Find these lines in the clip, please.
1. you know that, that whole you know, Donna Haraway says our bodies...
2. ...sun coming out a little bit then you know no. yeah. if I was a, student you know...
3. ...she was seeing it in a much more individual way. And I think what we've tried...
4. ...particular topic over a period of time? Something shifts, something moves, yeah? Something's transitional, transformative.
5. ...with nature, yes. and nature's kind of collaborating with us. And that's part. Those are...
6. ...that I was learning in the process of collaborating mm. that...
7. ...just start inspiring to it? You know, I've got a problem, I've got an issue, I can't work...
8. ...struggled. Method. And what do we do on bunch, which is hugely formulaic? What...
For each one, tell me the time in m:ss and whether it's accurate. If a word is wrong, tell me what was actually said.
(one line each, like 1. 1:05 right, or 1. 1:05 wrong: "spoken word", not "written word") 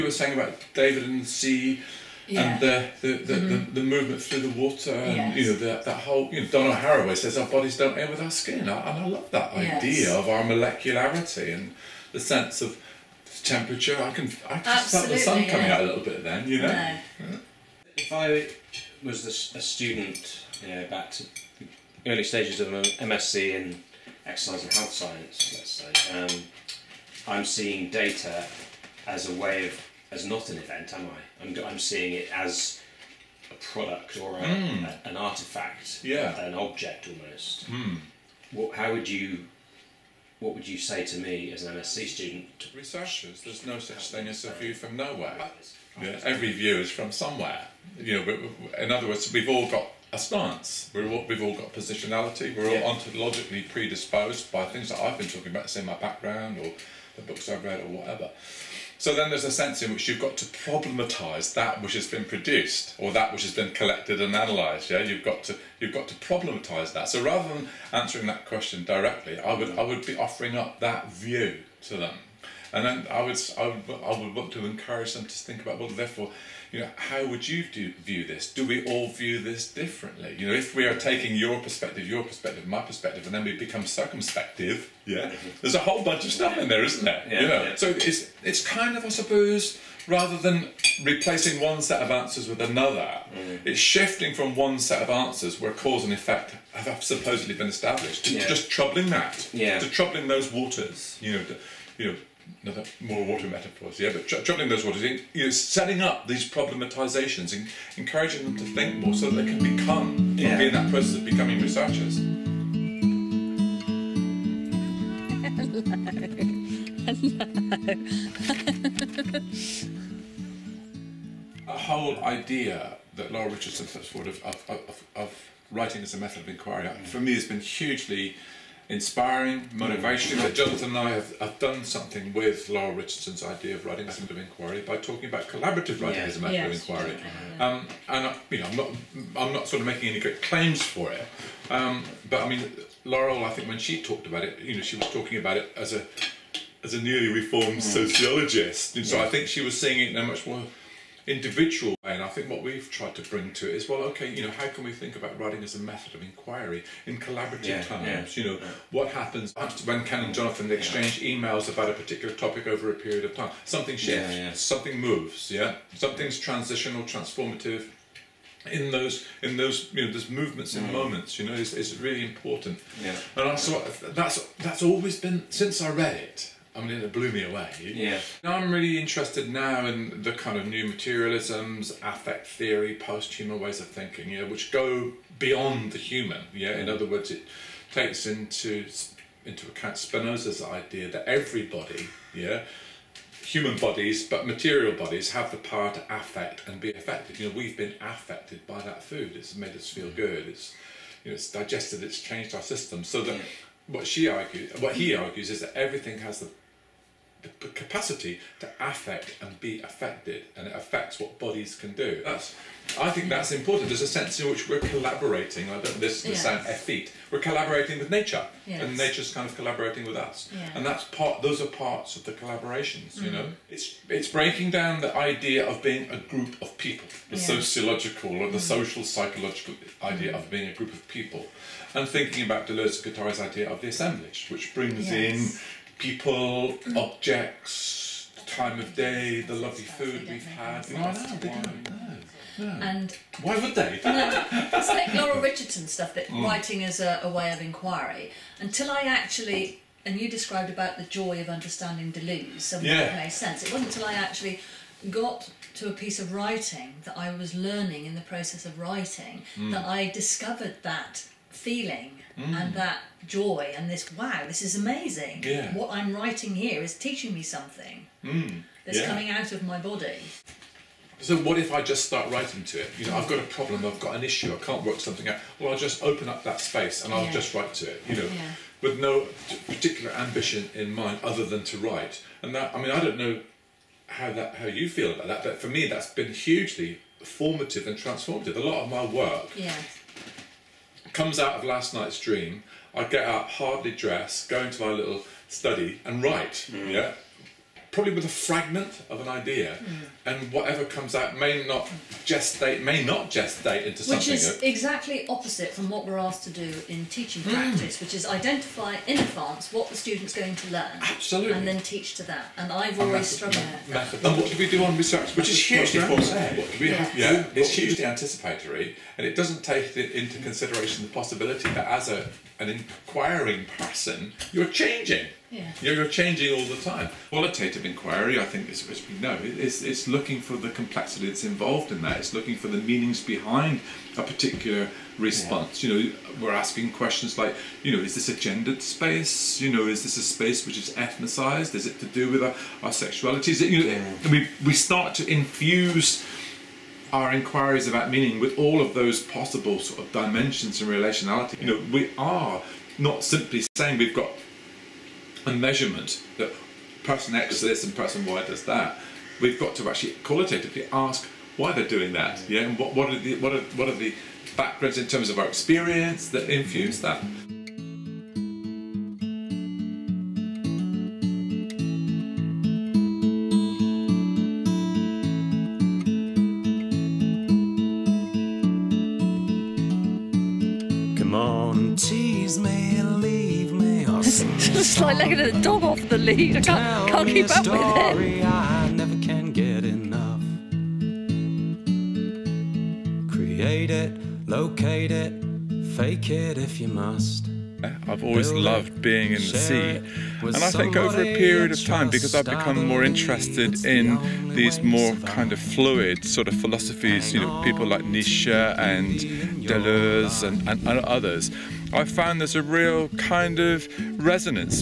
1. 0:05 right
2. 0:15 right
3. 2:29 right
4. 2:41 right
5. 3:37 right
6. 4:17 wrong: "writing", not "collaborating"
7. 4:31 wrong: "writing", not "inspiring"
8. 5:13 wrong: "research", not "bunch".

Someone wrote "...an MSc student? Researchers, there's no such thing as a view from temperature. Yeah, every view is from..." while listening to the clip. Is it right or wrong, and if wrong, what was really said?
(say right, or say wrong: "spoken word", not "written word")
wrong: "nowhere", not "temperature".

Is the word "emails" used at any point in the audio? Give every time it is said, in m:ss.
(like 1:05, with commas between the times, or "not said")
2:41.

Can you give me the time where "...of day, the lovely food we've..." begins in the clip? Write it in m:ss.
3:58.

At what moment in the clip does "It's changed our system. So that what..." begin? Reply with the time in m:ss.
3:22.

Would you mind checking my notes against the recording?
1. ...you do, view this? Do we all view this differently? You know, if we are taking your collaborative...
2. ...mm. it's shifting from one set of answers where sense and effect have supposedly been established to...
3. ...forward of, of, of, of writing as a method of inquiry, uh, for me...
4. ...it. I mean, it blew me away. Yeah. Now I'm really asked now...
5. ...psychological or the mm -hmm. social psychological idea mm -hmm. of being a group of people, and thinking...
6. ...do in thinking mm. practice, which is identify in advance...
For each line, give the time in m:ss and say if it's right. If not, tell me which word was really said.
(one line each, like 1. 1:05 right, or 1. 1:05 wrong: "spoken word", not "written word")
1. 1:17 wrong: "perspective", not "collaborative"
2. 1:33 wrong: "cause", not "sense"
3. 2:04 right
4. 2:56 wrong: "interested", not "asked"
5. 3:47 wrong: "sociological", not "psychological"
6. 5:06 wrong: "teaching", not "thinking".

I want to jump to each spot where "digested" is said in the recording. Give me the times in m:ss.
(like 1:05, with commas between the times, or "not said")
3:21.